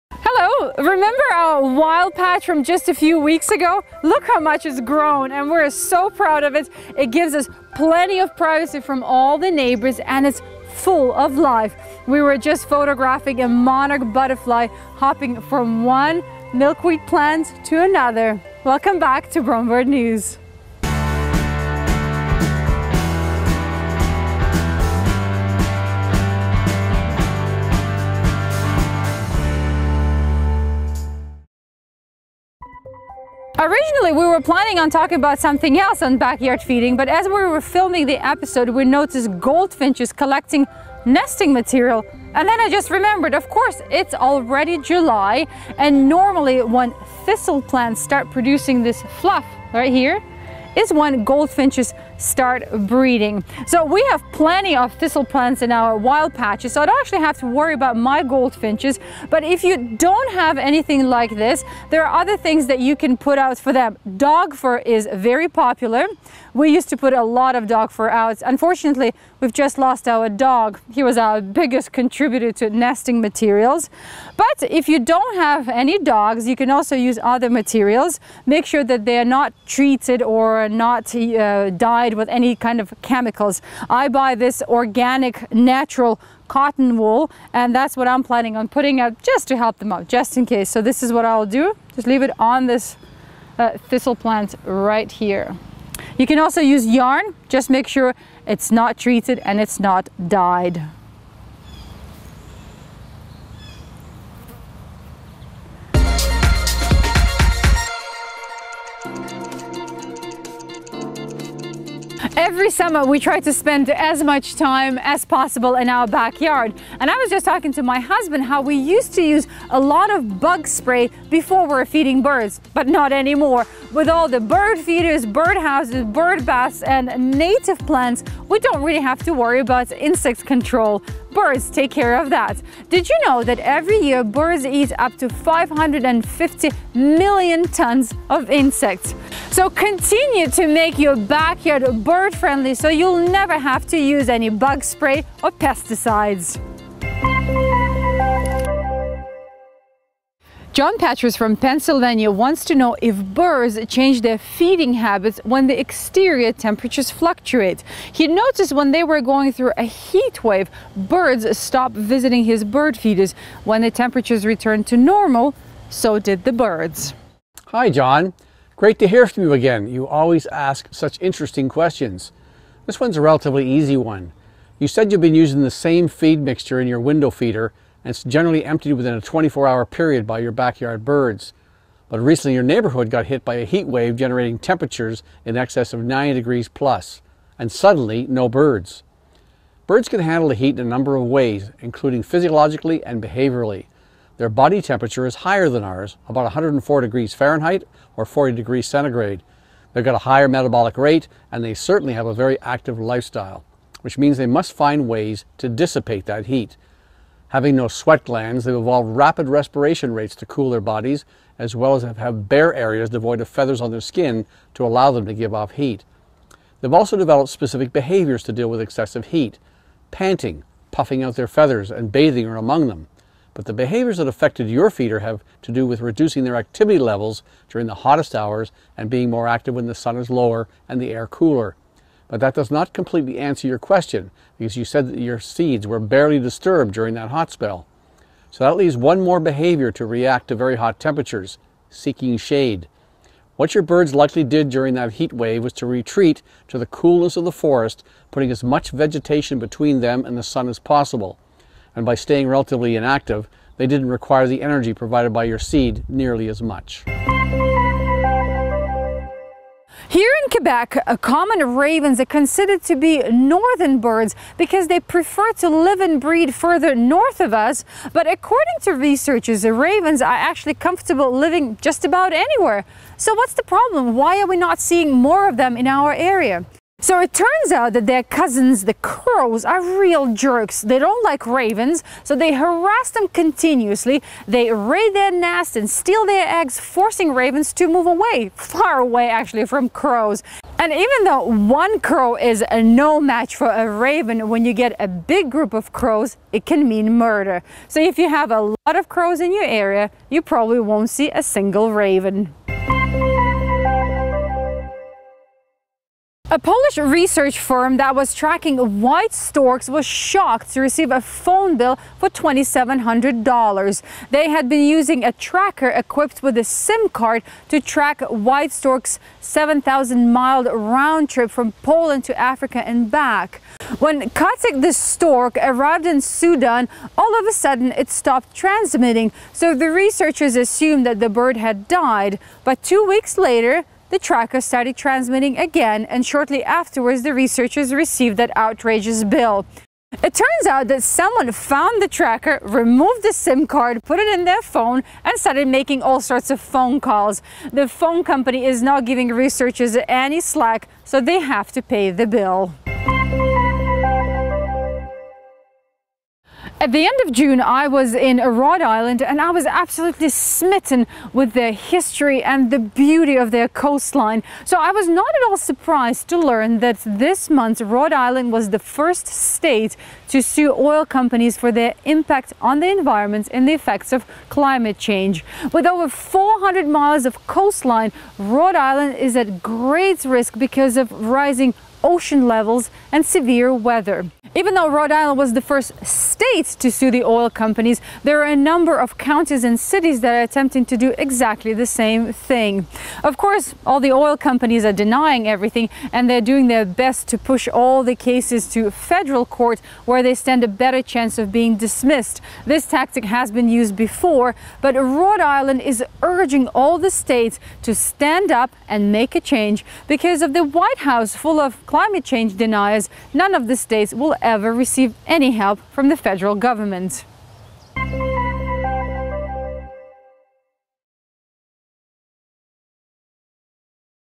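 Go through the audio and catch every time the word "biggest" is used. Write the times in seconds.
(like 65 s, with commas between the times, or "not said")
71 s.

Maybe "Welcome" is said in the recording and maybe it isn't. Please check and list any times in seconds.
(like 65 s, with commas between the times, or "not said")
18 s.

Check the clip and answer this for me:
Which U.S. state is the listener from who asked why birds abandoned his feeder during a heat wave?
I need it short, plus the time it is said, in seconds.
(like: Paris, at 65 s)
Pennsylvania, at 151 s.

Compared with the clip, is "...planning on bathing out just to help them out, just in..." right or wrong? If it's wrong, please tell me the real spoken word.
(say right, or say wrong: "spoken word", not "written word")
wrong: "putting", not "bathing".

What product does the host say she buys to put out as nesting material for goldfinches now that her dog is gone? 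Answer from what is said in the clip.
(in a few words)
organic, natural cotton wool.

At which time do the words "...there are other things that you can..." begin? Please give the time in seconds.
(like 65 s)
61 s.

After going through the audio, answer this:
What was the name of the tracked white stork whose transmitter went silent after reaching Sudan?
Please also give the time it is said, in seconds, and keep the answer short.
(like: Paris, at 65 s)
Kajtek, at 324 s.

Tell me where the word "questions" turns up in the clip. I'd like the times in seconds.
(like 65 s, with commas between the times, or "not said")
171 s, 233 s.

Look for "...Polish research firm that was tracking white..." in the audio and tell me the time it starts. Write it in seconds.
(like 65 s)
306 s.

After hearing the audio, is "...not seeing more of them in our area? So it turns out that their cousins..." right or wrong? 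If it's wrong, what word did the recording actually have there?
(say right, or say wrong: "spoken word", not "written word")
right.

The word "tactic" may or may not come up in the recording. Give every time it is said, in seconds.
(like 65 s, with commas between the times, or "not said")
402 s.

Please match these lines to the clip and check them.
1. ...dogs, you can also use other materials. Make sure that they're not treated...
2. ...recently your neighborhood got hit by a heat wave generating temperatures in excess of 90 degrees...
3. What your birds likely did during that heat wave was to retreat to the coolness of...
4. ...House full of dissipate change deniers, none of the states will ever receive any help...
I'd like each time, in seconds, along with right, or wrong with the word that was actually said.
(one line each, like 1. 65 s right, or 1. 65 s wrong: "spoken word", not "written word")
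1. 75 s right
2. 182 s right
3. 243 s right
4. 411 s wrong: "climate", not "dissipate".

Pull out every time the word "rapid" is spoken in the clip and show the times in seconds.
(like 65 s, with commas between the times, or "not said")
209 s.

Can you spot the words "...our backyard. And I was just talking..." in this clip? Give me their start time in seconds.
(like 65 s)
115 s.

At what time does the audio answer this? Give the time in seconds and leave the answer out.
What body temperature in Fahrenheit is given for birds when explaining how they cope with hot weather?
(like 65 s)
196 s.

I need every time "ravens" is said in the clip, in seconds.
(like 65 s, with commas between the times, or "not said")
261 s, 269 s, 281 s, 287 s, 293 s, 301 s.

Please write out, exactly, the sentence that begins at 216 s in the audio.
They've also developed specific behaviors to deal with excessive heat.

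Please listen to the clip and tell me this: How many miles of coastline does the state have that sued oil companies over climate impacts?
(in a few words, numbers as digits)
400.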